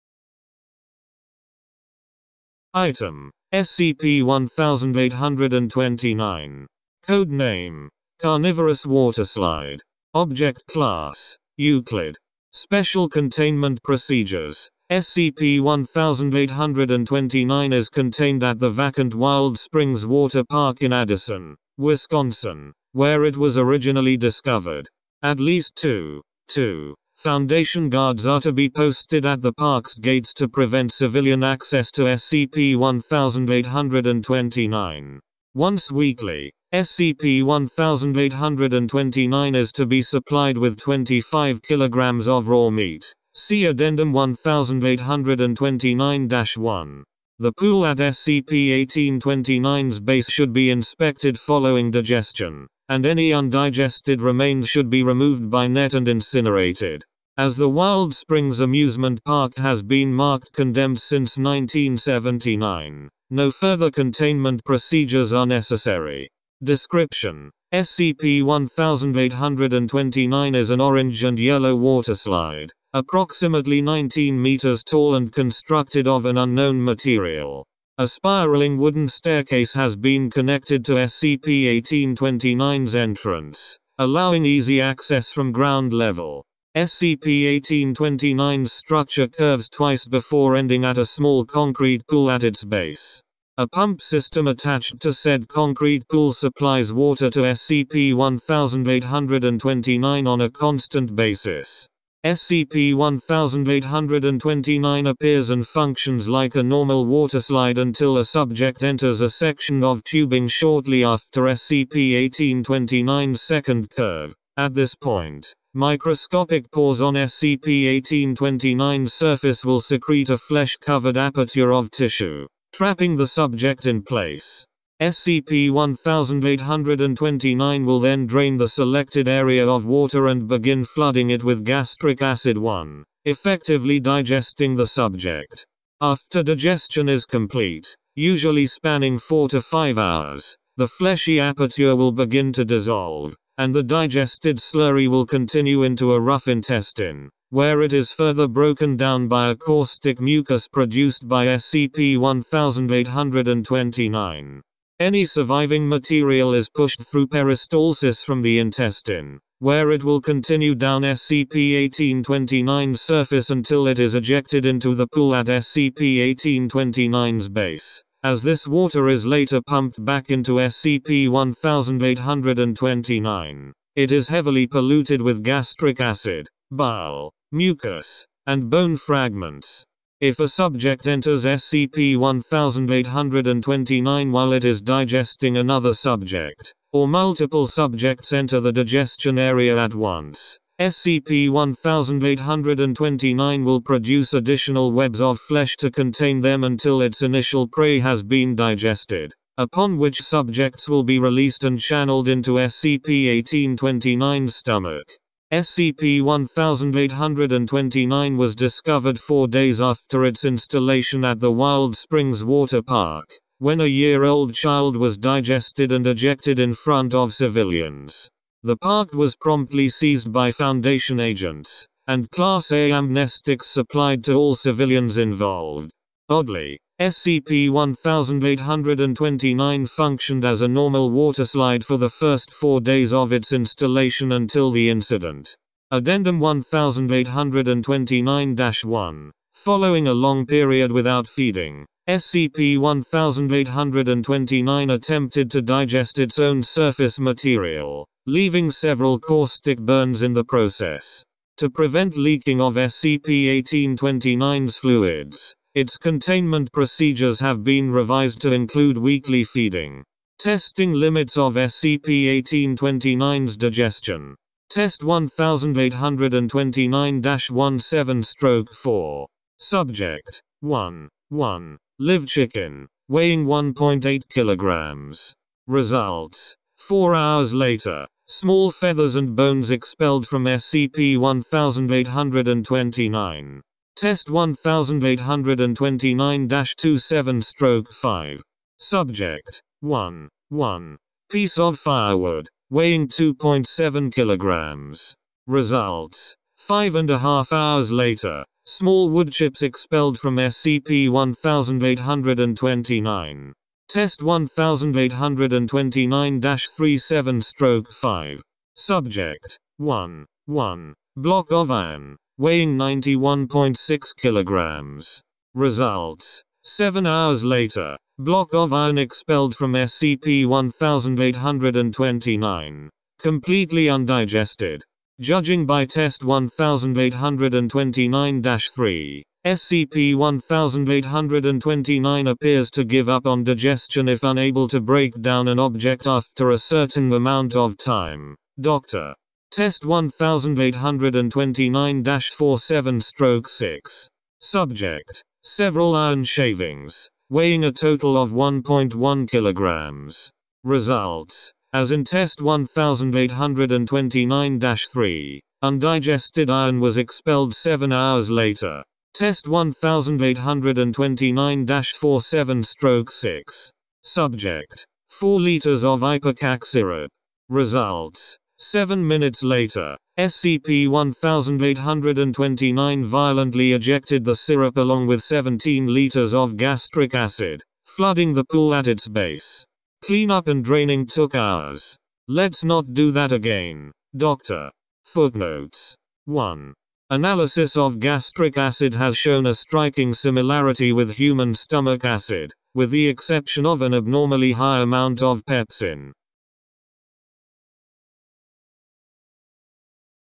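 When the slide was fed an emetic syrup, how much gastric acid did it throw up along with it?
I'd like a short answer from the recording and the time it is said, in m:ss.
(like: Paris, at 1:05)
17 liters, at 6:15.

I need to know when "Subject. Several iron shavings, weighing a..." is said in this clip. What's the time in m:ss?
5:44.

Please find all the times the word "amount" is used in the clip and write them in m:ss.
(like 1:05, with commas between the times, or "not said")
5:37, 6:34.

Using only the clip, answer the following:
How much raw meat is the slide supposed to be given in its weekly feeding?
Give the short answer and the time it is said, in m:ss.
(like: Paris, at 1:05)
25 kilograms, at 0:40.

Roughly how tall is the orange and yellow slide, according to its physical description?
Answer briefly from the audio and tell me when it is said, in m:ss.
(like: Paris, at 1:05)
19 meters, at 1:13.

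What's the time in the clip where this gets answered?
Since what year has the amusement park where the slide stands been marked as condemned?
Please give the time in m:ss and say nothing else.
1:01.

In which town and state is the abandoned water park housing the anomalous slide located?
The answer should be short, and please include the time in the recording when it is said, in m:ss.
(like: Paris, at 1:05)
Addison, Wisconsin, at 0:20.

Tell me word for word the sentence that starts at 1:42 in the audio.
SCP-1829 appears and functions like a normal water slide until a subject enters a section of tubing shortly after SCP-1829's second curve.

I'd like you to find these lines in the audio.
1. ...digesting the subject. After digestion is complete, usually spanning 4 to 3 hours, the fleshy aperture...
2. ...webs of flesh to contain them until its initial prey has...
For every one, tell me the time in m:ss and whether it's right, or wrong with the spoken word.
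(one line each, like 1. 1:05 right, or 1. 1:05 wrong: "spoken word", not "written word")
1. 2:14 wrong: "5", not "3"
2. 3:14 right.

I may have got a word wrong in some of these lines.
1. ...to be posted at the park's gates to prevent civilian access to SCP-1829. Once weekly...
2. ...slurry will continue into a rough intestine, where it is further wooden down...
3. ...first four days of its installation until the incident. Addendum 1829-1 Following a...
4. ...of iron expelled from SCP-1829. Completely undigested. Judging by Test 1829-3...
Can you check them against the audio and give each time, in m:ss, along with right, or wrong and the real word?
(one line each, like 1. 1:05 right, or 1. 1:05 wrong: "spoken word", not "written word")
1. 0:28 right
2. 2:24 wrong: "broken", not "wooden"
3. 3:52 right
4. 5:18 right.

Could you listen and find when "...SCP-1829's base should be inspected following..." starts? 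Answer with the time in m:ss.
0:47.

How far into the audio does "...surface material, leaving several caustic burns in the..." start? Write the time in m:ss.
4:06.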